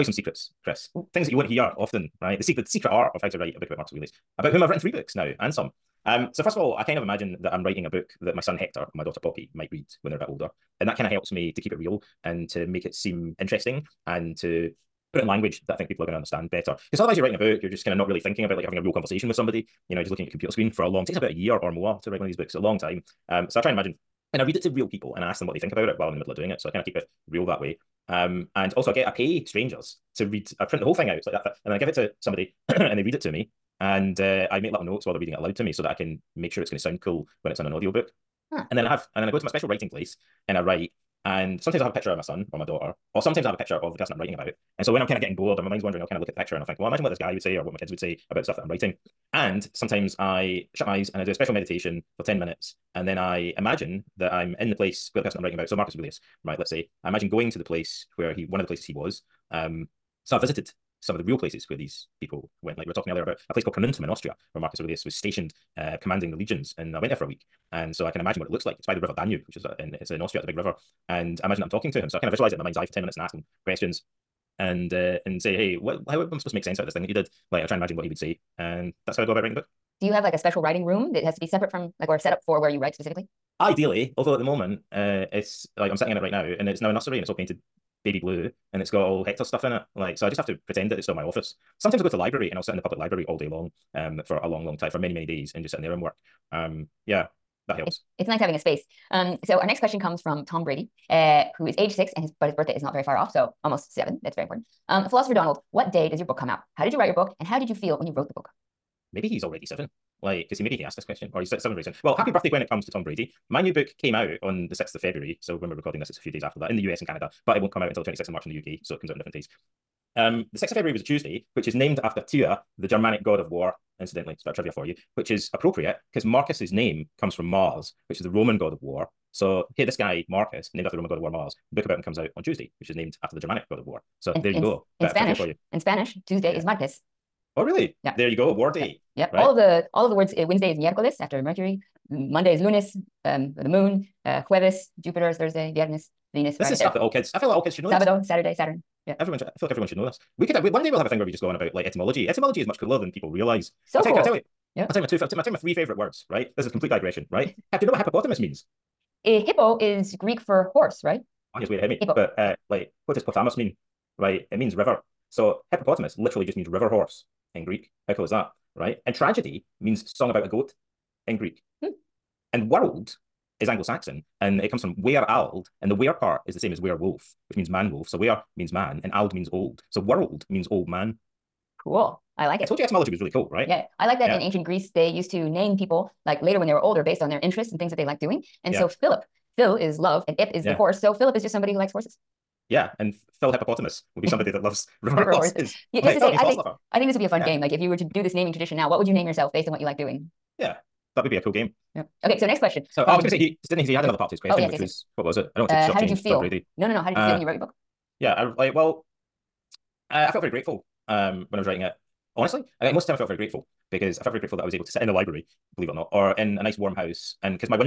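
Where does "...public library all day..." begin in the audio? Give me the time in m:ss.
1:32.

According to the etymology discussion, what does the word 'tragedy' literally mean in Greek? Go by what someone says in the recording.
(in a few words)
Song about a goat.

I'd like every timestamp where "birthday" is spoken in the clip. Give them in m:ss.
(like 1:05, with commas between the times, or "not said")
1:42, 1:52.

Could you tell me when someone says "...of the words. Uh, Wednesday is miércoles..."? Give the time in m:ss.
2:20.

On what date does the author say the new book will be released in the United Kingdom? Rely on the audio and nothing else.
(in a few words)
26th of March.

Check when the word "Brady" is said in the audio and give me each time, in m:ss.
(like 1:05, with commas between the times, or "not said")
1:40, 1:53, 3:26.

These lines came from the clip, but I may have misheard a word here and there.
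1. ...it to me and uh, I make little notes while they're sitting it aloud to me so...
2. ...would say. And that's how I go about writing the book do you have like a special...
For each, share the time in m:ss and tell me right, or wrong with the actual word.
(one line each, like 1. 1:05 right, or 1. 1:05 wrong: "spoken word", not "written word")
1. 0:33 wrong: "reading", not "sitting"
2. 1:18 right.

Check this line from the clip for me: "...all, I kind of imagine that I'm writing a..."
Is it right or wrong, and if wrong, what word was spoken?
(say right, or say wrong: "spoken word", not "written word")
right.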